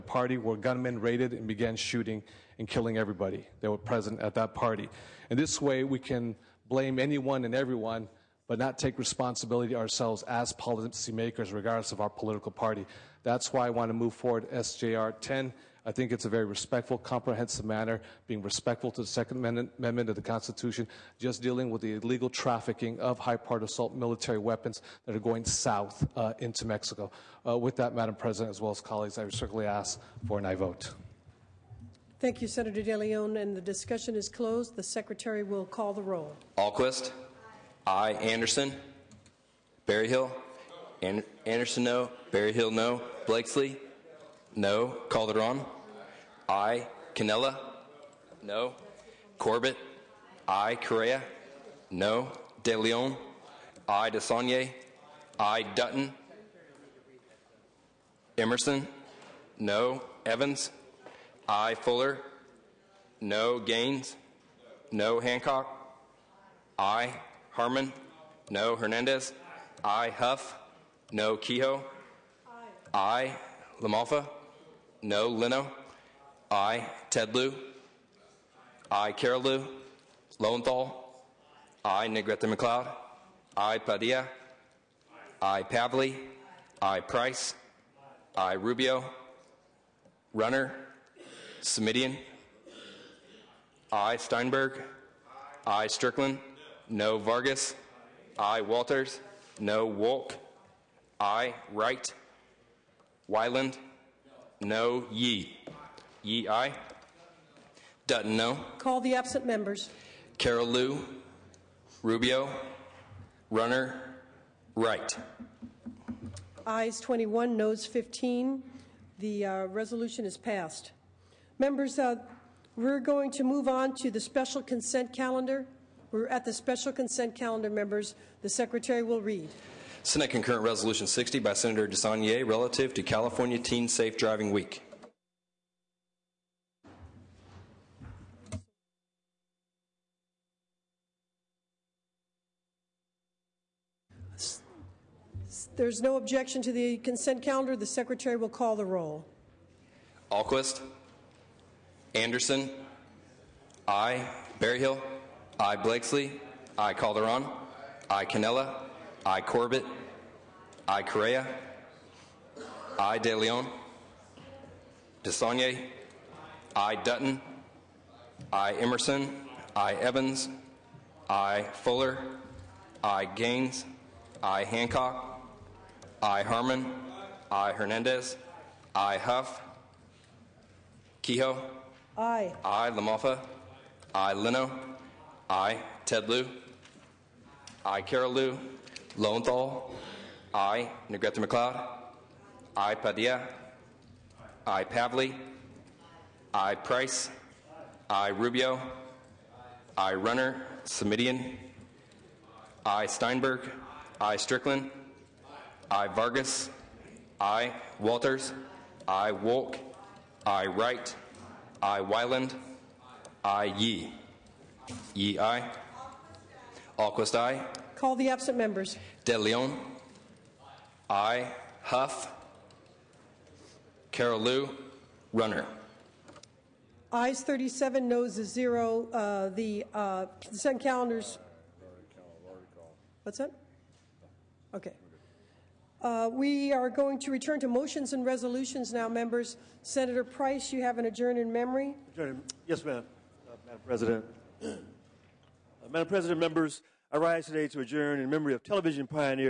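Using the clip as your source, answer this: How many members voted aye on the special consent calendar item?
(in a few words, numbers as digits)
37.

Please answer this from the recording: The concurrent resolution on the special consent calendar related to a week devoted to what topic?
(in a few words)
California Teen Safe Driving Week.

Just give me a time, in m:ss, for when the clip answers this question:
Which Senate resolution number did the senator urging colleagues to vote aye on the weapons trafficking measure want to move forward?
0:14.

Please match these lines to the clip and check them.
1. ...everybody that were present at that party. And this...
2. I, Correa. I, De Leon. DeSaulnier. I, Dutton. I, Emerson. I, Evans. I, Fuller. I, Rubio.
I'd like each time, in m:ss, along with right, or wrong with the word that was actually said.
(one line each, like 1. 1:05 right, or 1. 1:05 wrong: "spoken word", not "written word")
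1. 0:02 right
2. 2:40 wrong: "Gaines", not "Rubio".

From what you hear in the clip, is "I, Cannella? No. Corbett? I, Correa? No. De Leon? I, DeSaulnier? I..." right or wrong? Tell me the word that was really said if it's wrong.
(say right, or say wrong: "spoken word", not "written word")
right.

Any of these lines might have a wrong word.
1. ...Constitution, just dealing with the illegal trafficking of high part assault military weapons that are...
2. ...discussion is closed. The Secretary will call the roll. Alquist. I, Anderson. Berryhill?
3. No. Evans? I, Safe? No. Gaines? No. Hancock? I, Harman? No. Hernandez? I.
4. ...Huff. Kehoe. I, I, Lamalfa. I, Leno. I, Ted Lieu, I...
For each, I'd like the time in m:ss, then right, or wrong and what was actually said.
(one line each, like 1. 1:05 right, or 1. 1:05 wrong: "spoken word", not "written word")
1. 0:20 right
2. 0:33 right
3. 0:59 wrong: "Fuller", not "Safe"
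4. 2:59 right.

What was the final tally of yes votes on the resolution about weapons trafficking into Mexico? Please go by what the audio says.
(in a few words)
21.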